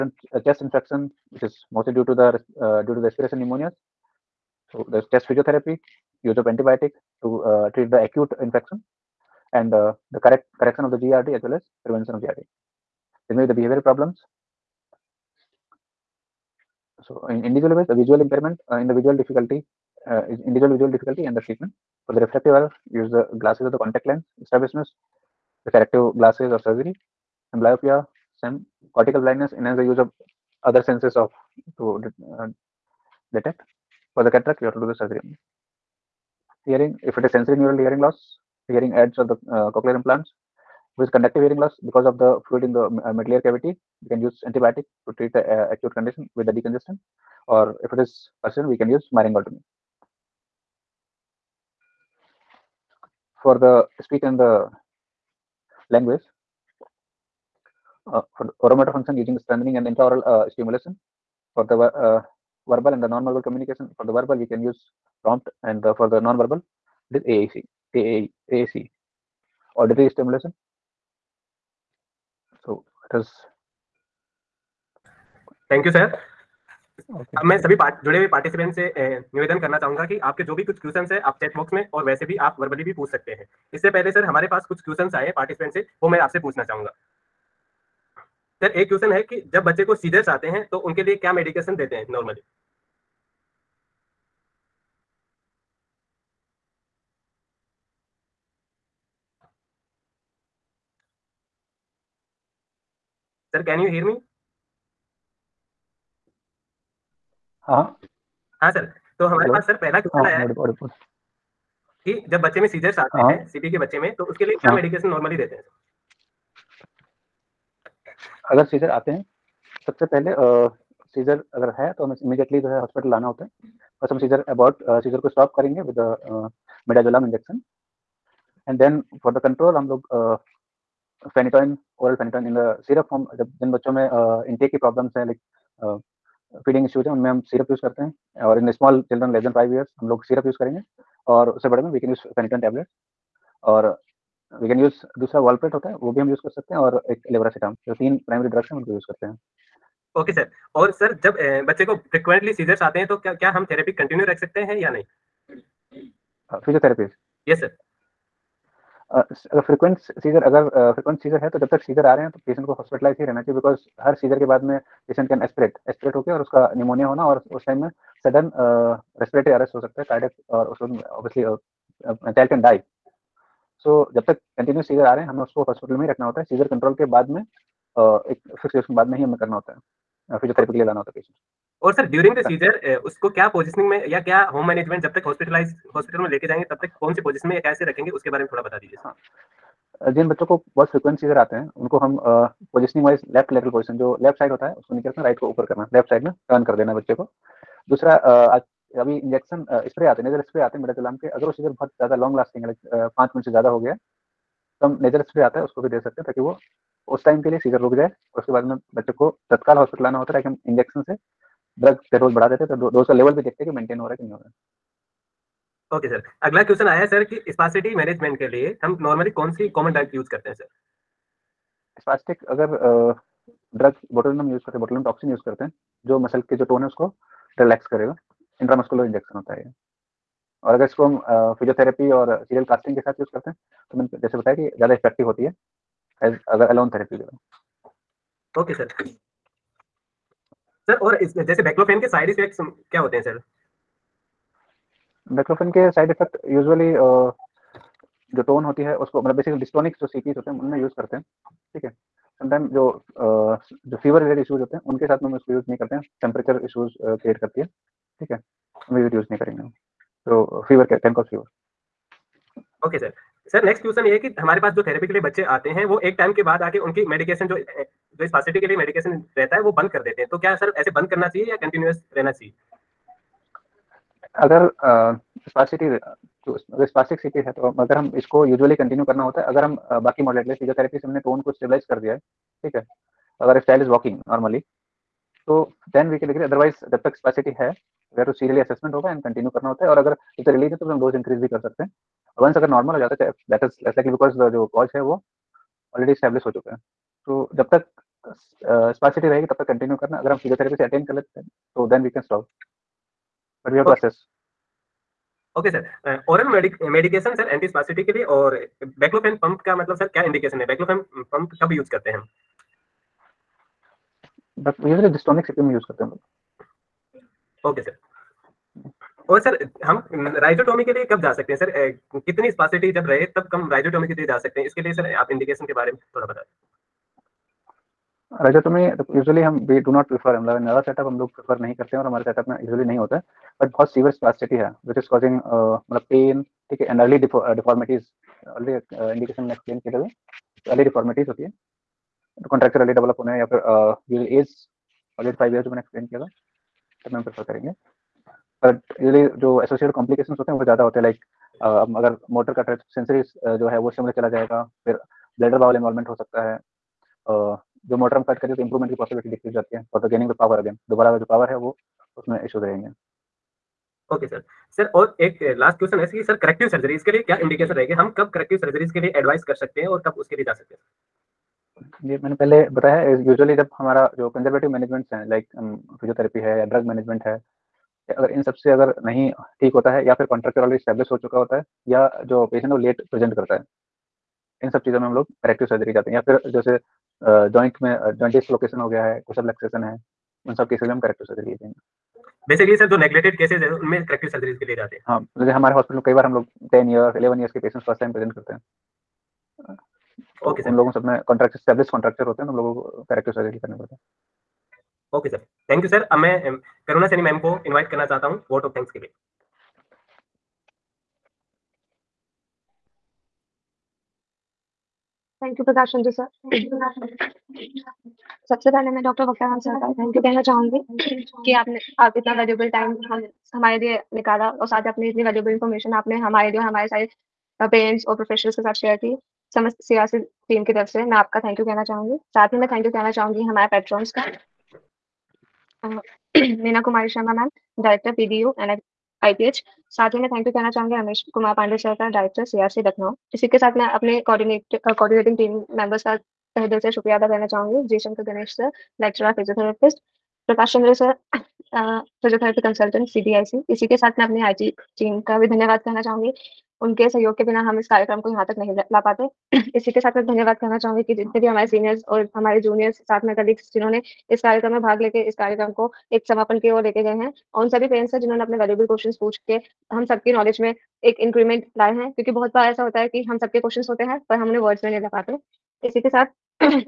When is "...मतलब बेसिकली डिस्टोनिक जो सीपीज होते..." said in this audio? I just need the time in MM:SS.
04:09.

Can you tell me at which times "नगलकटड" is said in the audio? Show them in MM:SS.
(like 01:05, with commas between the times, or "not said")
06:32.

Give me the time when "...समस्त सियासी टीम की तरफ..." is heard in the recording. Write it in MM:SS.
07:09.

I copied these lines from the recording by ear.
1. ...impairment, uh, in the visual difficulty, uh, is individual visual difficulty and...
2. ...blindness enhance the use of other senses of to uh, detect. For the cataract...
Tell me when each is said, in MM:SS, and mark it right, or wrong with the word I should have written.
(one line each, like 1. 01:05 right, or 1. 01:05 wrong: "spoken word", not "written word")
1. 00:18 right
2. 00:29 right.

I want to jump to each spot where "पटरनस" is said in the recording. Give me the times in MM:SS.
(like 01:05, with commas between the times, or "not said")
07:13.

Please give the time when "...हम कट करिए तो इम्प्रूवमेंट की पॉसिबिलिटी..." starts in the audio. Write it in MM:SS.
05:58.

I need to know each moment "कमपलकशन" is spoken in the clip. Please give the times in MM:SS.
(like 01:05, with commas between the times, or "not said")
05:49.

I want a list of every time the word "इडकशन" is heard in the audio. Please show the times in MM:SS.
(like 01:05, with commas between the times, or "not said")
05:10, 05:25, 05:39, 06:07.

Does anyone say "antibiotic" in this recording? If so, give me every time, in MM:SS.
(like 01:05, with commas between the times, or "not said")
00:06, 00:44.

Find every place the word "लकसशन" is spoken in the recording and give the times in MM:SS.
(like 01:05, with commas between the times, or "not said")
06:29.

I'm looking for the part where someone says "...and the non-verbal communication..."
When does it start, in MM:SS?
01:02.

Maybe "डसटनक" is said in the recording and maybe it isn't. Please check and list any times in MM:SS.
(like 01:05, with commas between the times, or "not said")
04:09, 05:15.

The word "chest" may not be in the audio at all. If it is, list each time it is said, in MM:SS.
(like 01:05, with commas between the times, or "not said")
00:00, 00:05.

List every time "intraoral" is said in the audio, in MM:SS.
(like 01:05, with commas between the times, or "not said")
00:59.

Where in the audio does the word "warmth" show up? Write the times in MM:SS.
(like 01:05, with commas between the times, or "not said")
not said.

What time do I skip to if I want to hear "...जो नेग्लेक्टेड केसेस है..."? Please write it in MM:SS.
06:32.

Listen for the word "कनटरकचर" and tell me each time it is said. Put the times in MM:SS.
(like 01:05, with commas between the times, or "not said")
05:42, 06:20.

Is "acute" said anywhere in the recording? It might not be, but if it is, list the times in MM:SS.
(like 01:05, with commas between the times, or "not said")
00:08, 00:45.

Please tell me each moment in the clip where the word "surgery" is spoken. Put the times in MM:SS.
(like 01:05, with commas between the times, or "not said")
00:26, 00:34.